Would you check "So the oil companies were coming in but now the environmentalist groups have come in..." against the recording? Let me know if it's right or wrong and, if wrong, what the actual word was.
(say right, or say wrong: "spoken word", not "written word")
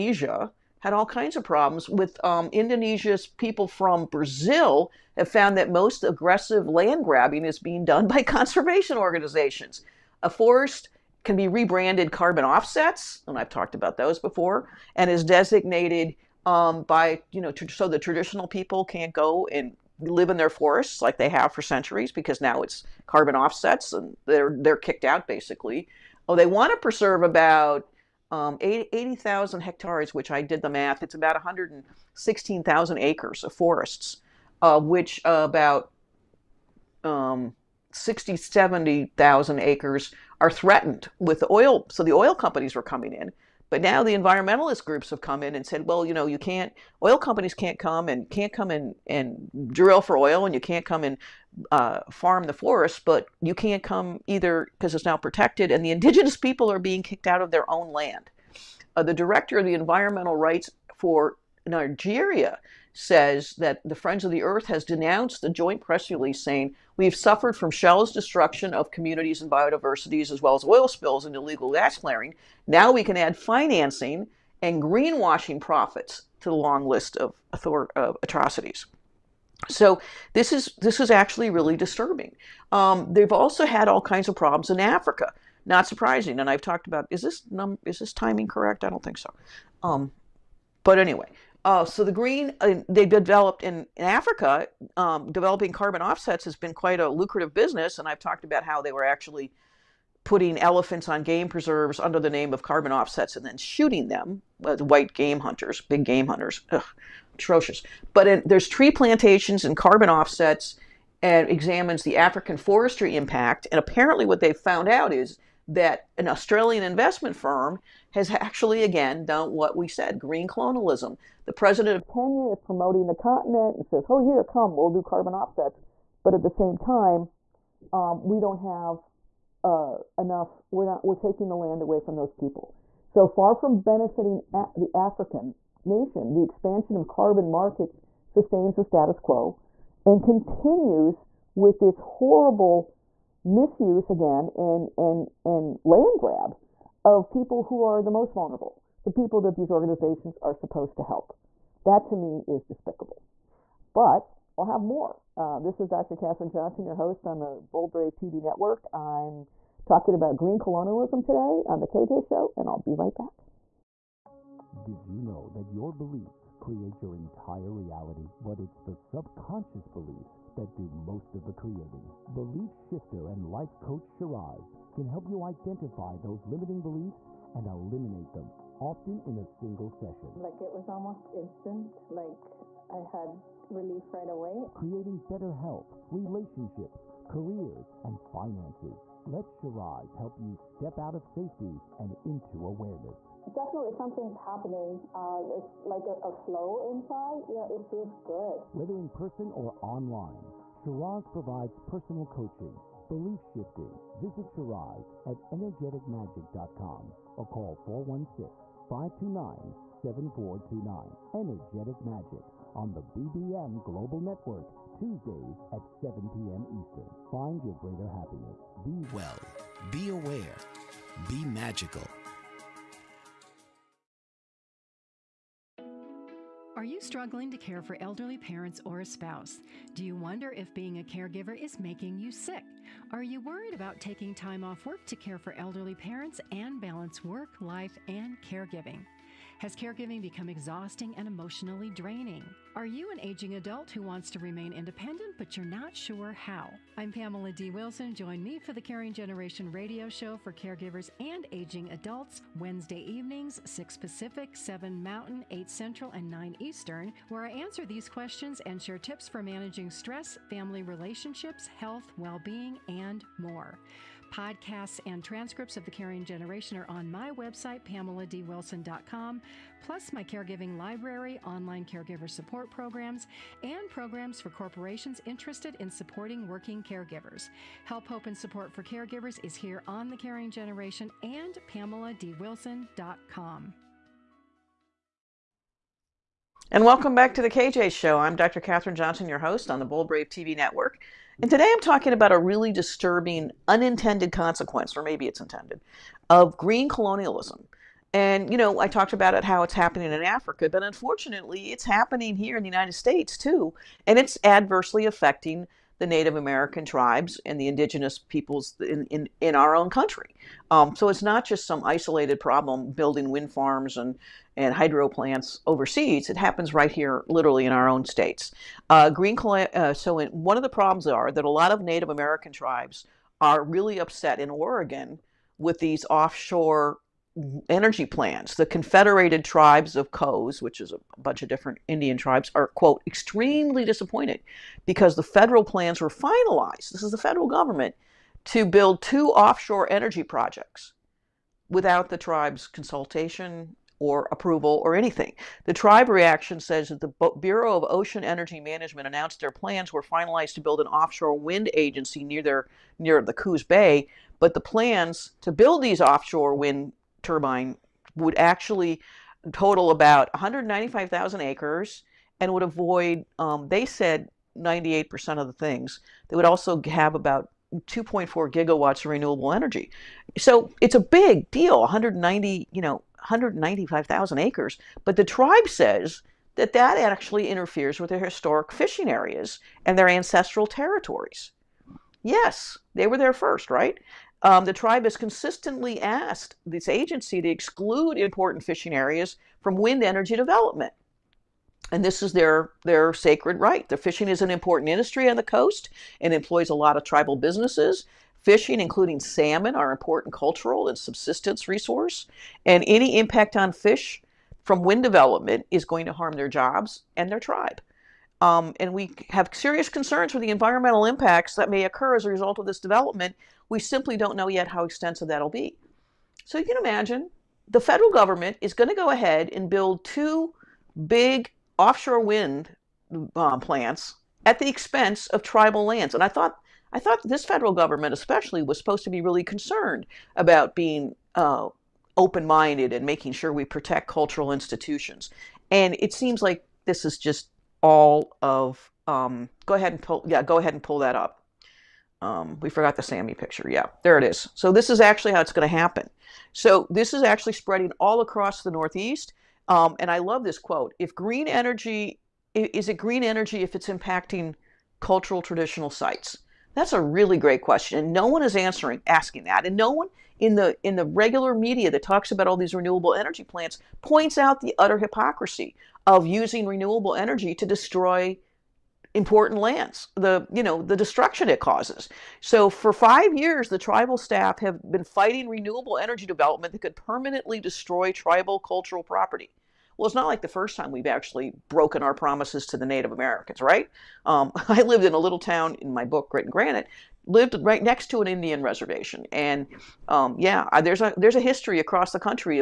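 right.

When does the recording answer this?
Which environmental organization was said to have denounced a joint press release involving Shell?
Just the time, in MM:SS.
01:03.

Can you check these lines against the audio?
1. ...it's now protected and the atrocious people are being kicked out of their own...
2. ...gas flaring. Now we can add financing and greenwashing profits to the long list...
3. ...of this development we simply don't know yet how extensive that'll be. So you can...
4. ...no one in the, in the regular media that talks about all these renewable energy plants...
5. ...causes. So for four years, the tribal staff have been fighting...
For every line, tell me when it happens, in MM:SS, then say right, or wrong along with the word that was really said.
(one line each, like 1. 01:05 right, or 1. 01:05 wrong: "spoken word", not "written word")
1. 00:54 wrong: "indigenous", not "atrocious"
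2. 01:11 right
3. 06:52 right
4. 07:39 right
5. 07:51 wrong: "five", not "four".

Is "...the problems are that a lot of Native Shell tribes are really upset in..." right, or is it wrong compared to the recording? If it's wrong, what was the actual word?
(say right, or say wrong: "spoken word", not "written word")
wrong: "American", not "Shell".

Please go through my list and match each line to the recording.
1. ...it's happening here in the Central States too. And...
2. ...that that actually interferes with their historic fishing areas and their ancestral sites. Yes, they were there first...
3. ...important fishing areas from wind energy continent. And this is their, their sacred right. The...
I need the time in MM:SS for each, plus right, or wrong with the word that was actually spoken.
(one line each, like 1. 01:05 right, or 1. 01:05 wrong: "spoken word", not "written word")
1. 05:01 wrong: "United", not "Central"
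2. 06:16 wrong: "territories", not "sites"
3. 06:28 wrong: "development", not "continent".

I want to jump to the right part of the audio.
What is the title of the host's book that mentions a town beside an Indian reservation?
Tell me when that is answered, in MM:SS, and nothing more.
08:06.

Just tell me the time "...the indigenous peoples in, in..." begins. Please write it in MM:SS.
05:07.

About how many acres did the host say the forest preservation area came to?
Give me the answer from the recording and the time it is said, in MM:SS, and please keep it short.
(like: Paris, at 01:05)
116,000 acres, at 00:31.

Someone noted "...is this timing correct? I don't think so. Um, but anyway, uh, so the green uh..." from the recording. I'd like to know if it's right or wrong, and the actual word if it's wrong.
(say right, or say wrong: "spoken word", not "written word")
right.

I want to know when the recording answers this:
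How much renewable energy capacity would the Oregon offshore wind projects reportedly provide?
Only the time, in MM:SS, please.
06:07.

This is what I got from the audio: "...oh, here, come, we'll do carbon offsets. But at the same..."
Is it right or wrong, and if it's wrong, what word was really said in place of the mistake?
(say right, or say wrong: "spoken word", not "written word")
right.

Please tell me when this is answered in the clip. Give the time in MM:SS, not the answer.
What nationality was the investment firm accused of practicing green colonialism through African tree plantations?
01:56.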